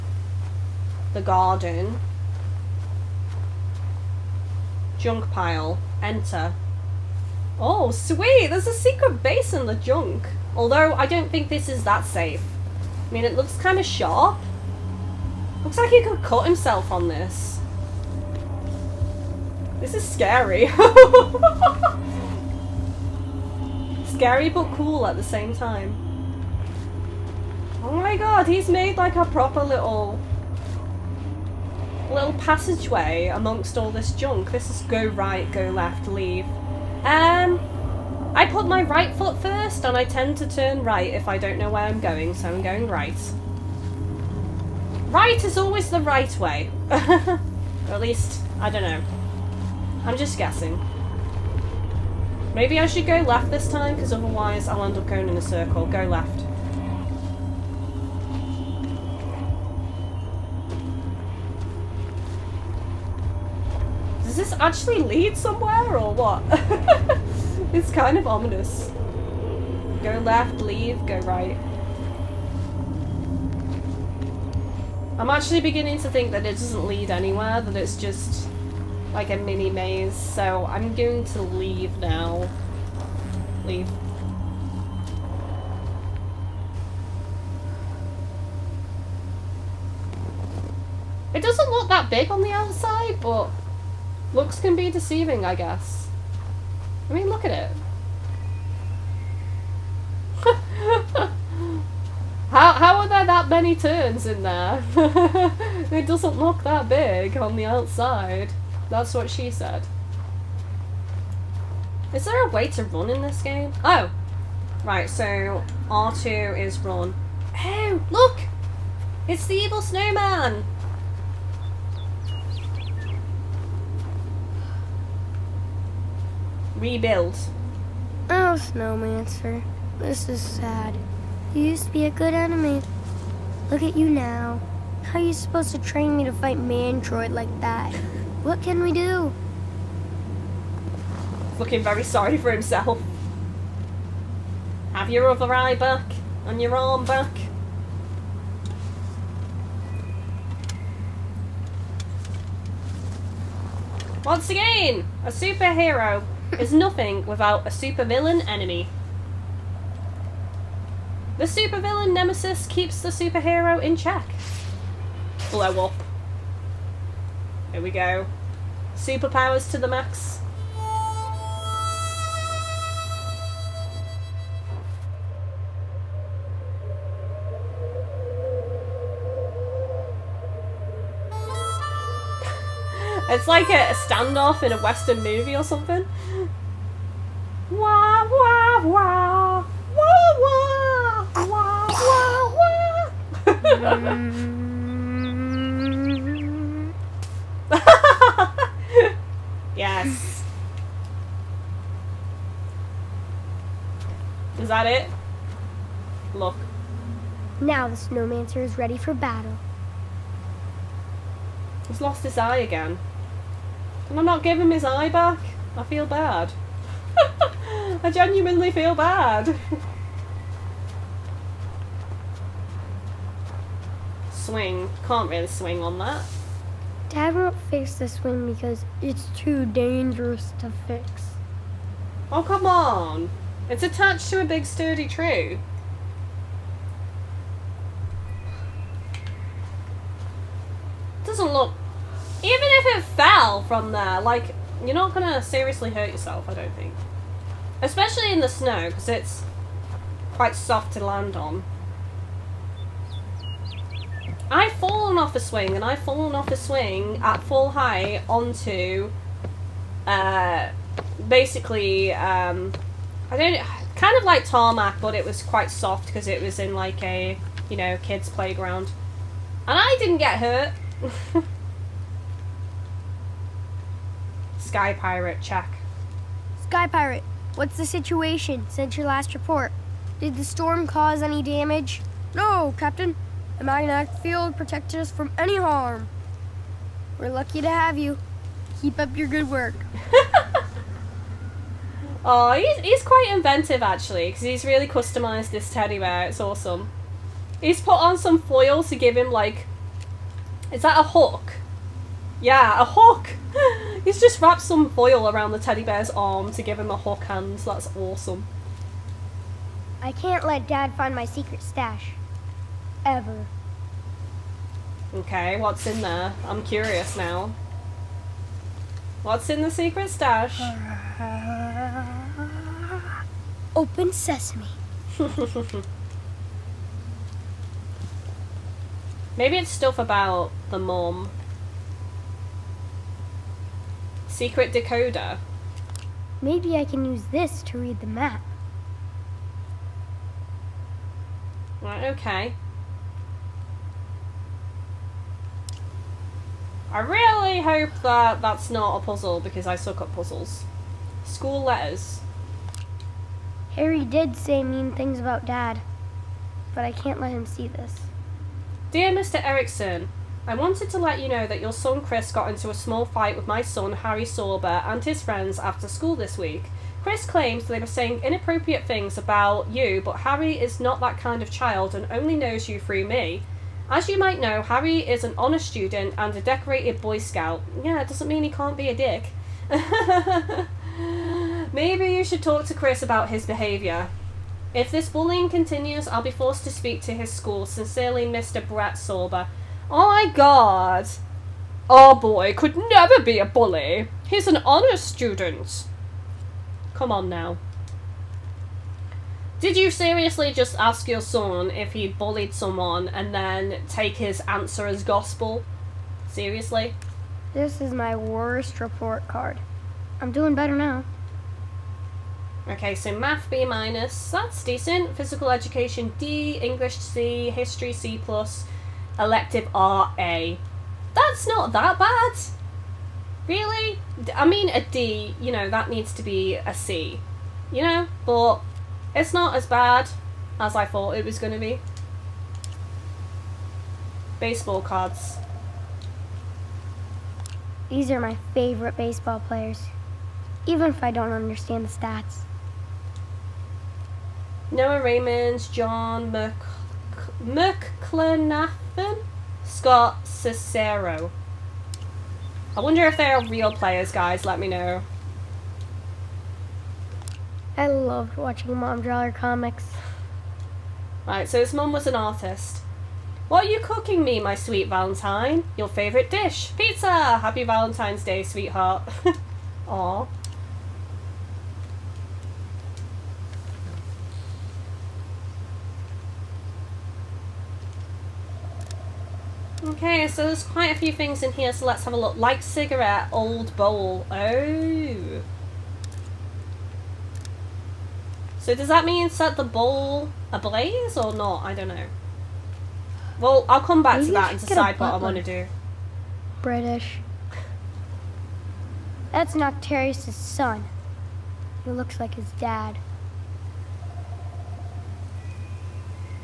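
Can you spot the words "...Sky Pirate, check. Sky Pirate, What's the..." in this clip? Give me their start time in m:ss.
4:34.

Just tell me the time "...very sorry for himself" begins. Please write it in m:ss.
2:21.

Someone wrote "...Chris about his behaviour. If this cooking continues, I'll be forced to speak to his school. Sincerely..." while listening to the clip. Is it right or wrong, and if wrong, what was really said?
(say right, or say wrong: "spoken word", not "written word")
wrong: "bullying", not "cooking".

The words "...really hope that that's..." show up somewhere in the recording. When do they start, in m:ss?
5:46.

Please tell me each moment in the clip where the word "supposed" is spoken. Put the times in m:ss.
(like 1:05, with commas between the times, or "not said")
2:15.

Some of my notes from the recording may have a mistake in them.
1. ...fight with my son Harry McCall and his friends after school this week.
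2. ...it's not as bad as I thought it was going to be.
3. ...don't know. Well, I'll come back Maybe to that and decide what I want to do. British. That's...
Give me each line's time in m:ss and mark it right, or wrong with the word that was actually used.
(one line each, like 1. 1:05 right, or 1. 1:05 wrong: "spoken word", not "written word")
1. 6:03 wrong: "Sorber", not "McCall"
2. 7:09 right
3. 8:11 right.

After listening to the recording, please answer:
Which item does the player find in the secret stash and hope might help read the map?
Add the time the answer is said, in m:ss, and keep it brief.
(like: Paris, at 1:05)
Secret decoder, at 5:34.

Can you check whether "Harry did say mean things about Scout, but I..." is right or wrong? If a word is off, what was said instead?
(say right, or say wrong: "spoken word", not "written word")
wrong: "Dad", not "Scout".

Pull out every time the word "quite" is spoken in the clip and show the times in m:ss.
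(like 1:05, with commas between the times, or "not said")
4:10, 4:25, 4:53, 8:00.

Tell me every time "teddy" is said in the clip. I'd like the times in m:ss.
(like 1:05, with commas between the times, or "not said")
4:55, 5:05.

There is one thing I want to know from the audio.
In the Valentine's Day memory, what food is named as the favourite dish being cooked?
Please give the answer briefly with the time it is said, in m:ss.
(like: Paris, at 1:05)
Pizza, at 7:46.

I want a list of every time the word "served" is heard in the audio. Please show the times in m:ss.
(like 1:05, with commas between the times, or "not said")
not said.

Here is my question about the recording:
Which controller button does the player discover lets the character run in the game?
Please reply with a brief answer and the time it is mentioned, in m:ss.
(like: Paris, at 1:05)
R2, at 1:55.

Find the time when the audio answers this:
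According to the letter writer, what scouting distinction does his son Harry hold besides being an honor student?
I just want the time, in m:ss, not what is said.
6:16.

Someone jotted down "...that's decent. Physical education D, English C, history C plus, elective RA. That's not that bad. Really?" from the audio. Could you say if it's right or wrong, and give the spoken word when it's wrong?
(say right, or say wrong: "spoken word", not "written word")
right.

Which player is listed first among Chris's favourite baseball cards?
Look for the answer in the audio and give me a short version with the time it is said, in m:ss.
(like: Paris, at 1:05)
Noah Raymond, at 7:24.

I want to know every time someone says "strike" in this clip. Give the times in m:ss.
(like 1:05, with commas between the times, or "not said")
not said.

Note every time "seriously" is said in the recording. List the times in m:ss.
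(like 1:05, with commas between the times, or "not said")
4:05, 6:39, 6:46.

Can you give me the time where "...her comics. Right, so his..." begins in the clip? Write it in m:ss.
7:39.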